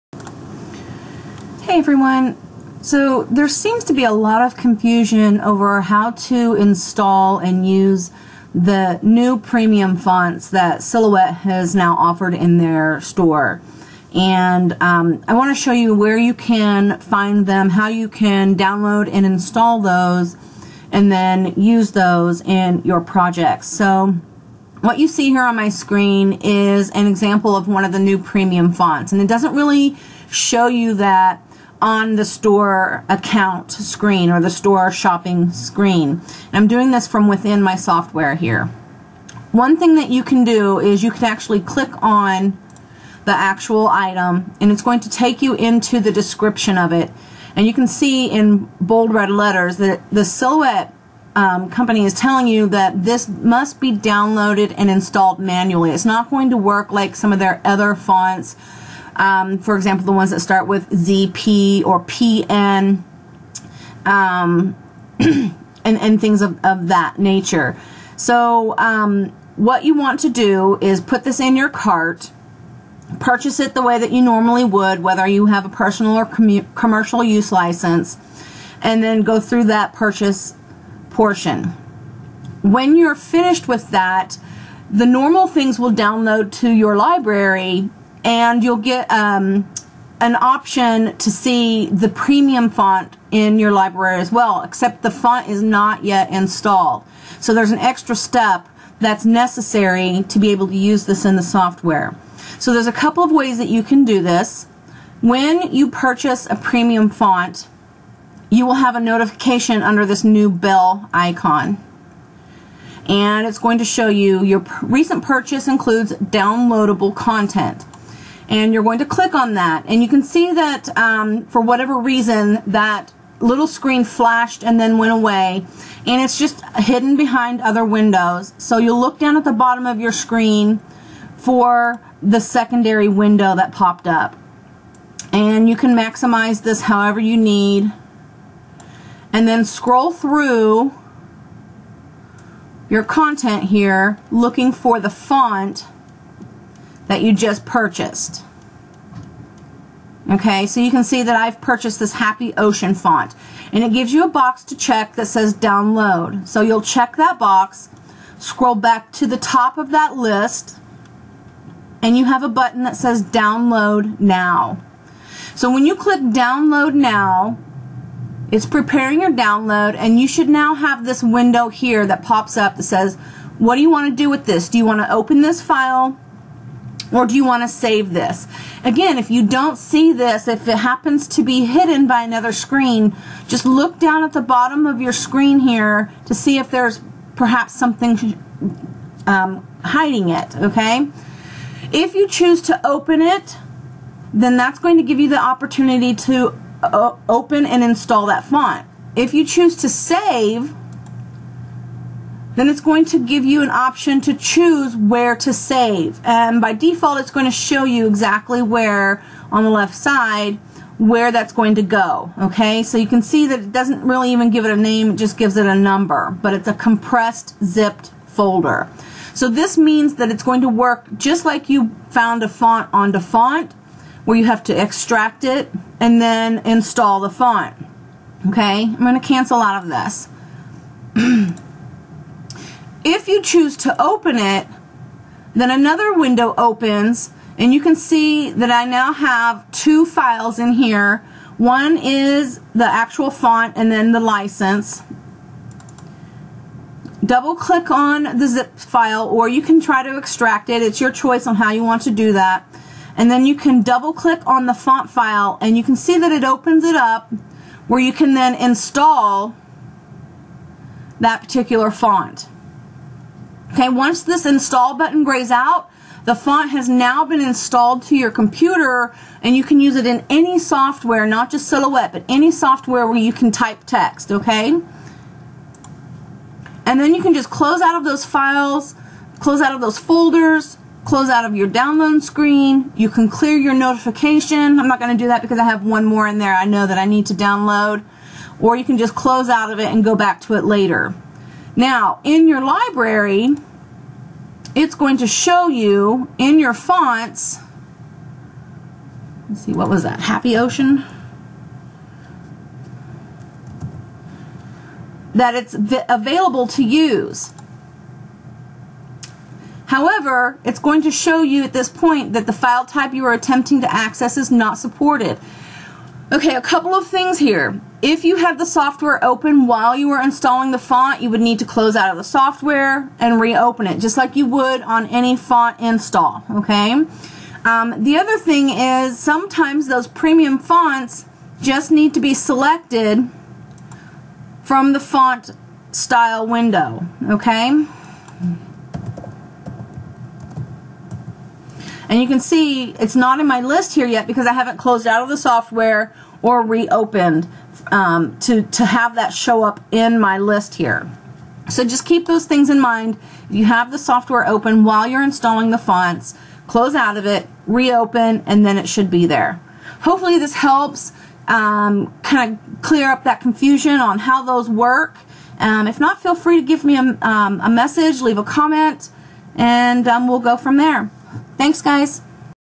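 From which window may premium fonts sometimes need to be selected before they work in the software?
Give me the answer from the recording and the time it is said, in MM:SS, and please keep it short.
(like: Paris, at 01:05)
Font style window, at 05:35.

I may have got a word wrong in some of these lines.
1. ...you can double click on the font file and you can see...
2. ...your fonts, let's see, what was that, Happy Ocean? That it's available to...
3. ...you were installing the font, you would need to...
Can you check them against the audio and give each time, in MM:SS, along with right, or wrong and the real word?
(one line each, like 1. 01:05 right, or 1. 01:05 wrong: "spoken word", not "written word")
1. 04:13 right
2. 04:56 right
3. 05:19 right.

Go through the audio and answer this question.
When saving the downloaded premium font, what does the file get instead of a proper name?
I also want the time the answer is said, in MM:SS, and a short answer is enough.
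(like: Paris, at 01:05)
A number, at 03:35.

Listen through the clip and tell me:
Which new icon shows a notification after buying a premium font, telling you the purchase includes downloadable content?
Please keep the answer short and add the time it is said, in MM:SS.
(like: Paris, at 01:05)
Bell icon, at 01:50.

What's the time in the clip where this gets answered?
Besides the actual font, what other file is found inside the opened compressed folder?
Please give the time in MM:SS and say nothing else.
04:04.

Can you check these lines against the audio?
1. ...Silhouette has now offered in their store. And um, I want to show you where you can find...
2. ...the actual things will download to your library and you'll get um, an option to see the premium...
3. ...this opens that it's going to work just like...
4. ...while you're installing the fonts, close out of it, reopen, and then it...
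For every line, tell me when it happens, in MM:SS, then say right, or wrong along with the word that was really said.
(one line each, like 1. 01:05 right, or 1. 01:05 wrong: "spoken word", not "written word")
1. 00:10 right
2. 01:24 wrong: "normal", not "actual"
3. 03:39 wrong: "means", not "opens"
4. 05:54 right.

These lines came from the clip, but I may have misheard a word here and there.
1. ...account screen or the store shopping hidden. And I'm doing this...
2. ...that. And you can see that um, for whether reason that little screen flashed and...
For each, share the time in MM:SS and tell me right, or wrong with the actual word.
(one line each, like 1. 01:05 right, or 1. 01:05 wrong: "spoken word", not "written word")
1. 00:33 wrong: "screen", not "hidden"
2. 01:59 wrong: "whatever", not "whether".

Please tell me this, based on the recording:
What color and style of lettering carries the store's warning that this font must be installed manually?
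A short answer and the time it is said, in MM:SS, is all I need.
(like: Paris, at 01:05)
Bold red, at 00:48.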